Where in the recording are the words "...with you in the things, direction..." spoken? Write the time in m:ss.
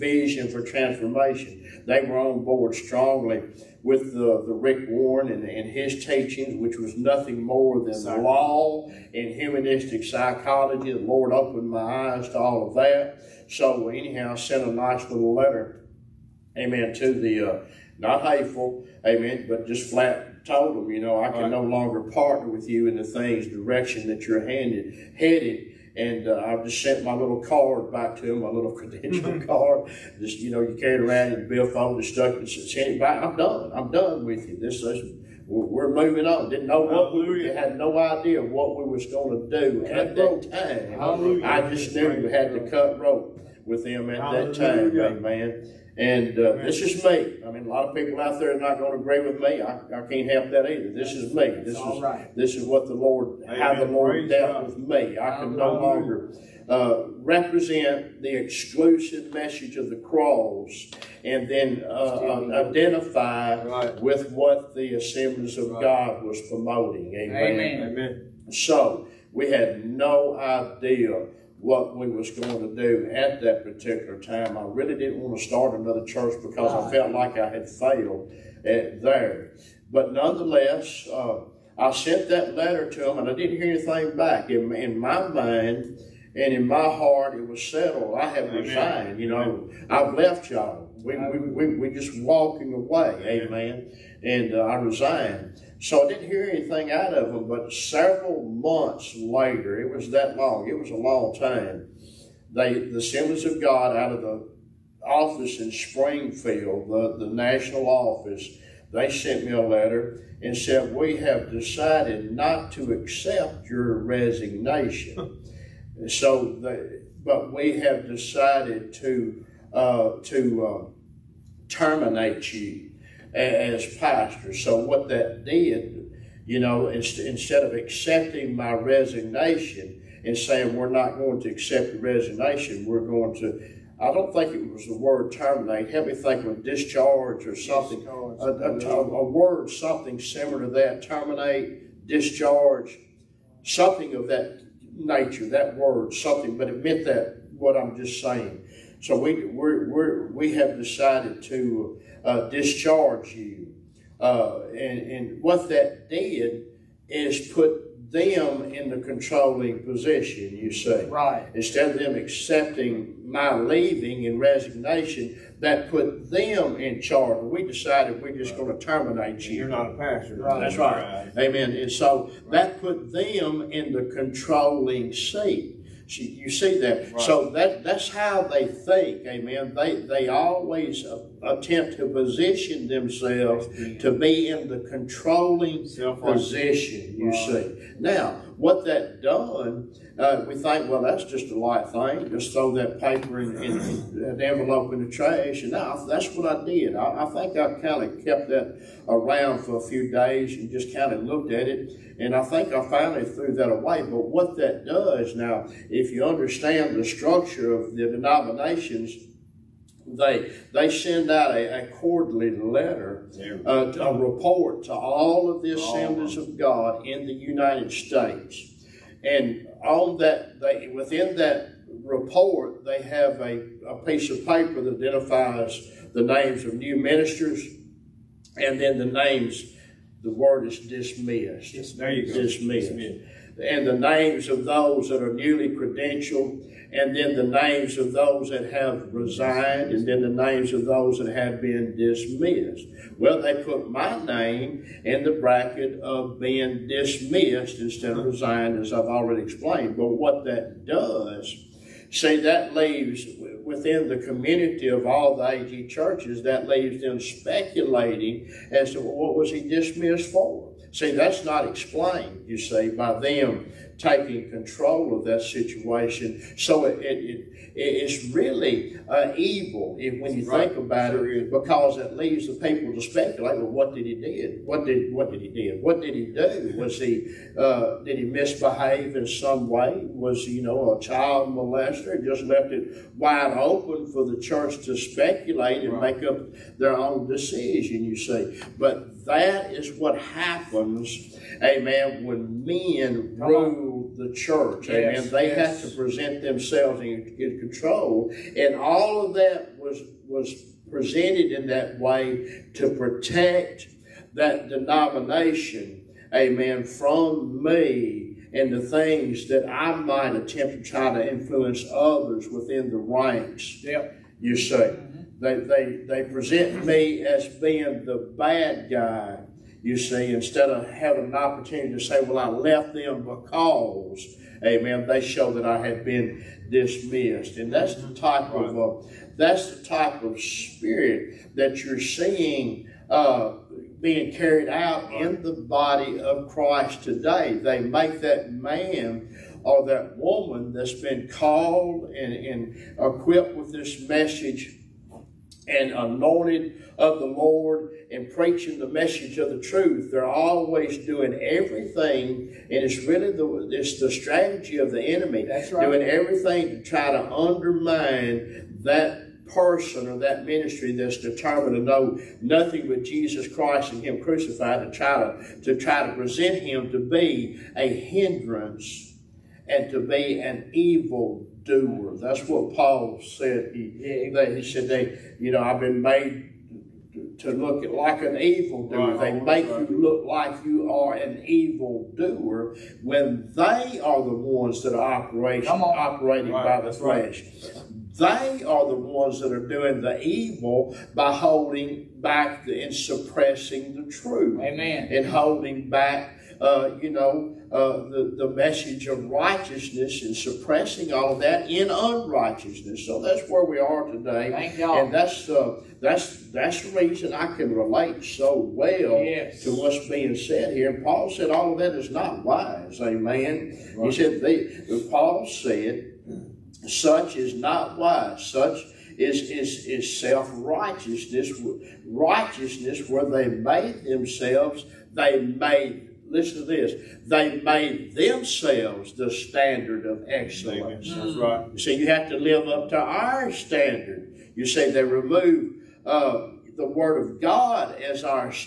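0:22.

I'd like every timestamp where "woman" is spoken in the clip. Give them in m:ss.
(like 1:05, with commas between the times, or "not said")
5:40.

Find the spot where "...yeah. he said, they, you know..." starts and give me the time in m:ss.
6:14.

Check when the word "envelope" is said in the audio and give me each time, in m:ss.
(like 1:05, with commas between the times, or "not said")
3:14.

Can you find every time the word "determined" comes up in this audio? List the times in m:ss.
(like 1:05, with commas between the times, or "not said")
6:01.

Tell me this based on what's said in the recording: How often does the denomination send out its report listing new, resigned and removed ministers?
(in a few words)
Quarterly.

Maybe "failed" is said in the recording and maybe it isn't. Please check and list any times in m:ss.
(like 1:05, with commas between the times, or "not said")
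1:17.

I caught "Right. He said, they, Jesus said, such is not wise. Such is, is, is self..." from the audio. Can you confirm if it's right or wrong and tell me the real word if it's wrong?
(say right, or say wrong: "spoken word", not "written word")
wrong: "Paul", not "Jesus".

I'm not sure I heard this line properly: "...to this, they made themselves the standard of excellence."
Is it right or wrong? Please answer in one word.
right.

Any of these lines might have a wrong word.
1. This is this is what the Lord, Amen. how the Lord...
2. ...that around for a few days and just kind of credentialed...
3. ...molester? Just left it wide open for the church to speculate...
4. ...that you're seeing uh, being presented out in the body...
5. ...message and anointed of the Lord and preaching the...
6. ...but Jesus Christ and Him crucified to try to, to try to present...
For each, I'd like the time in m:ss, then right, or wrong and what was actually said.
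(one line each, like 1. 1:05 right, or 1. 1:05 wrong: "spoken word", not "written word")
1. 0:51 right
2. 3:18 wrong: "looked", not "credentialed"
3. 4:41 right
4. 5:31 wrong: "carried", not "presented"
5. 5:44 right
6. 6:02 right.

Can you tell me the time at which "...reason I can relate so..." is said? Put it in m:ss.
6:46.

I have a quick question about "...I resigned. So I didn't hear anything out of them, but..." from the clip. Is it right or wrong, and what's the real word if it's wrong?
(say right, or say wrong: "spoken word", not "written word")
right.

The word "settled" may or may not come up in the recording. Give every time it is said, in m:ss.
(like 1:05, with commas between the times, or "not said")
1:27.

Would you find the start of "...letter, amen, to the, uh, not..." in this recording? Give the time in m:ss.
0:15.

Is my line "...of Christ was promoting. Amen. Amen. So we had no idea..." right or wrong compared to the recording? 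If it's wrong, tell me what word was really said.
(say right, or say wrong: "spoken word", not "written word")
wrong: "God", not "Christ".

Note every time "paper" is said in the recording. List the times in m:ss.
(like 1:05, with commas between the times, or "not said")
3:12, 3:44.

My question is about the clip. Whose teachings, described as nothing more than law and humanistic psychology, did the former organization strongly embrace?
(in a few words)
Rick Warren.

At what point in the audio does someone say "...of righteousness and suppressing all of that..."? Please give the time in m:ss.
6:39.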